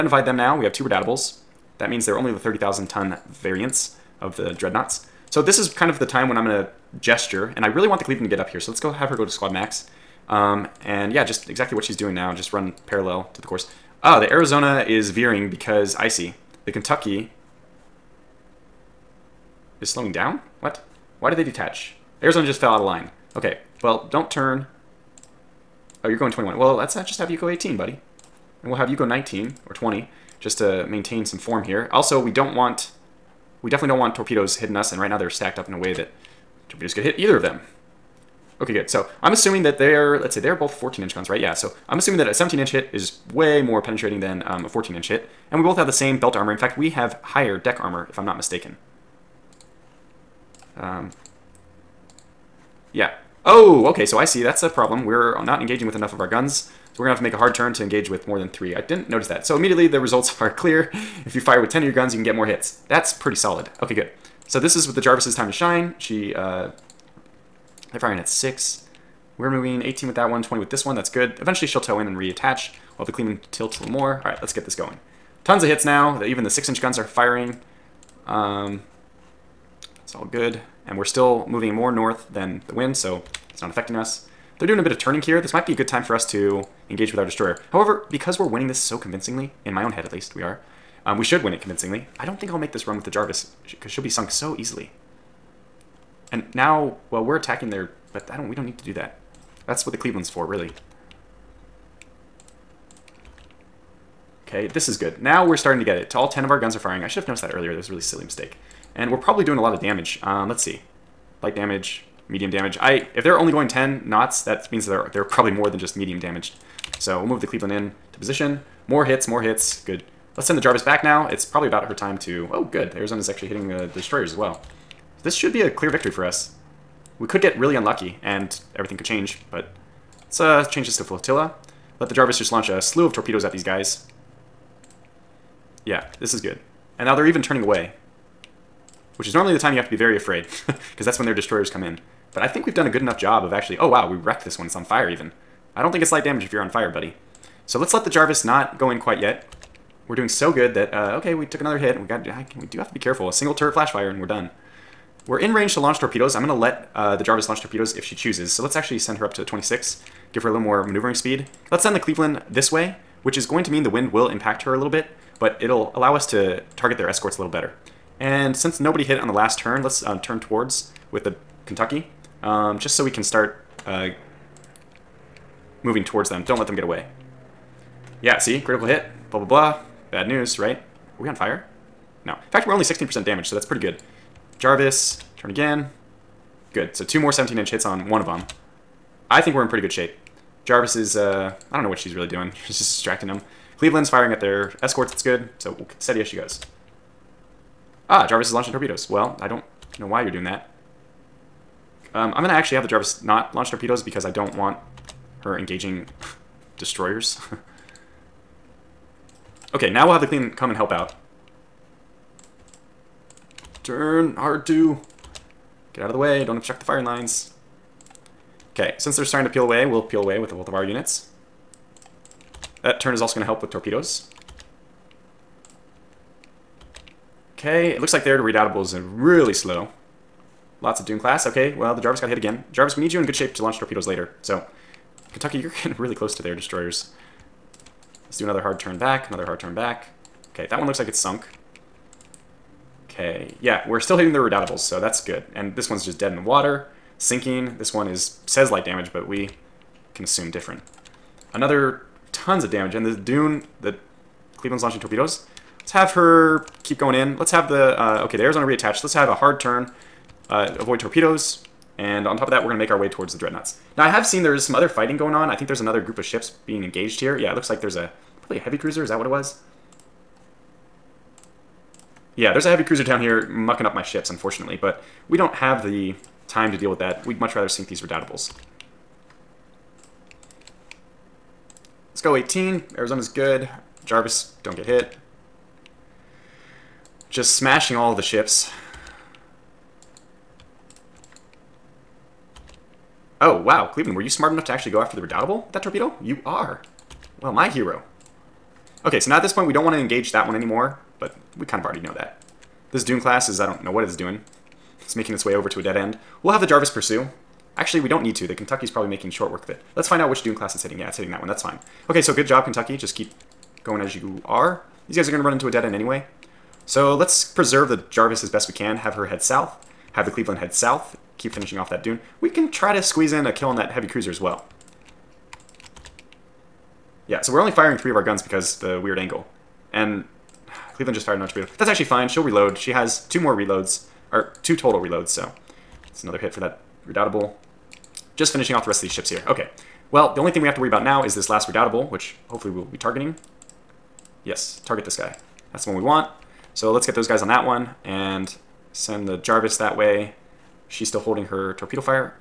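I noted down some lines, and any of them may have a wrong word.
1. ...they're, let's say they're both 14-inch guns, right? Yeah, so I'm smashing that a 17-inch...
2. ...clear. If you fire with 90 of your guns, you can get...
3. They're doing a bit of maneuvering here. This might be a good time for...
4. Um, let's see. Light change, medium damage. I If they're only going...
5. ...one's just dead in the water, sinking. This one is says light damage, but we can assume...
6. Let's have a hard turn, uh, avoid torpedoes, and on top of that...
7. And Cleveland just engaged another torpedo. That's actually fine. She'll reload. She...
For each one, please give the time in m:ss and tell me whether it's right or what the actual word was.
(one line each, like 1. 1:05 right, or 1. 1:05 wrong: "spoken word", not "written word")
1. 0:39 wrong: "assuming", not "smashing"
2. 1:00 wrong: "10", not "90"
3. 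1:24 wrong: "turning", not "maneuvering"
4. 1:50 wrong: "damage", not "change"
5. 4:05 right
6. 4:19 right
7. 5:29 wrong: "fired", not "engaged".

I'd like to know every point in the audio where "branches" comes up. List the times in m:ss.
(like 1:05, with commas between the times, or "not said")
not said.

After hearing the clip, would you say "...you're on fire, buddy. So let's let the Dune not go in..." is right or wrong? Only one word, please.
wrong.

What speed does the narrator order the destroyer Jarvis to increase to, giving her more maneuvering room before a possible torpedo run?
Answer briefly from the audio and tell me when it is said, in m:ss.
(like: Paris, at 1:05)
26, at 2:39.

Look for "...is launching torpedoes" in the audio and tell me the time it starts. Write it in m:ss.
3:18.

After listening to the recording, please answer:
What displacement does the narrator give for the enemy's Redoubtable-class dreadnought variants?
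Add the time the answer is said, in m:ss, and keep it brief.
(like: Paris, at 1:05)
30,000 tons, at 0:02.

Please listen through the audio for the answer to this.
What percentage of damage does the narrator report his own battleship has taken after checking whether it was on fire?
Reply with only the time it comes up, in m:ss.
3:02.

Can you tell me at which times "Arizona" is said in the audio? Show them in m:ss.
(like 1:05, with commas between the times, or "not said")
0:14, 0:22, 2:02, 4:18, 4:42.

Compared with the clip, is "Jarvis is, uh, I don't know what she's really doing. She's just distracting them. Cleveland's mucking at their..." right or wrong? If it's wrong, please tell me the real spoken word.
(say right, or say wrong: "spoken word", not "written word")
wrong: "firing", not "mucking".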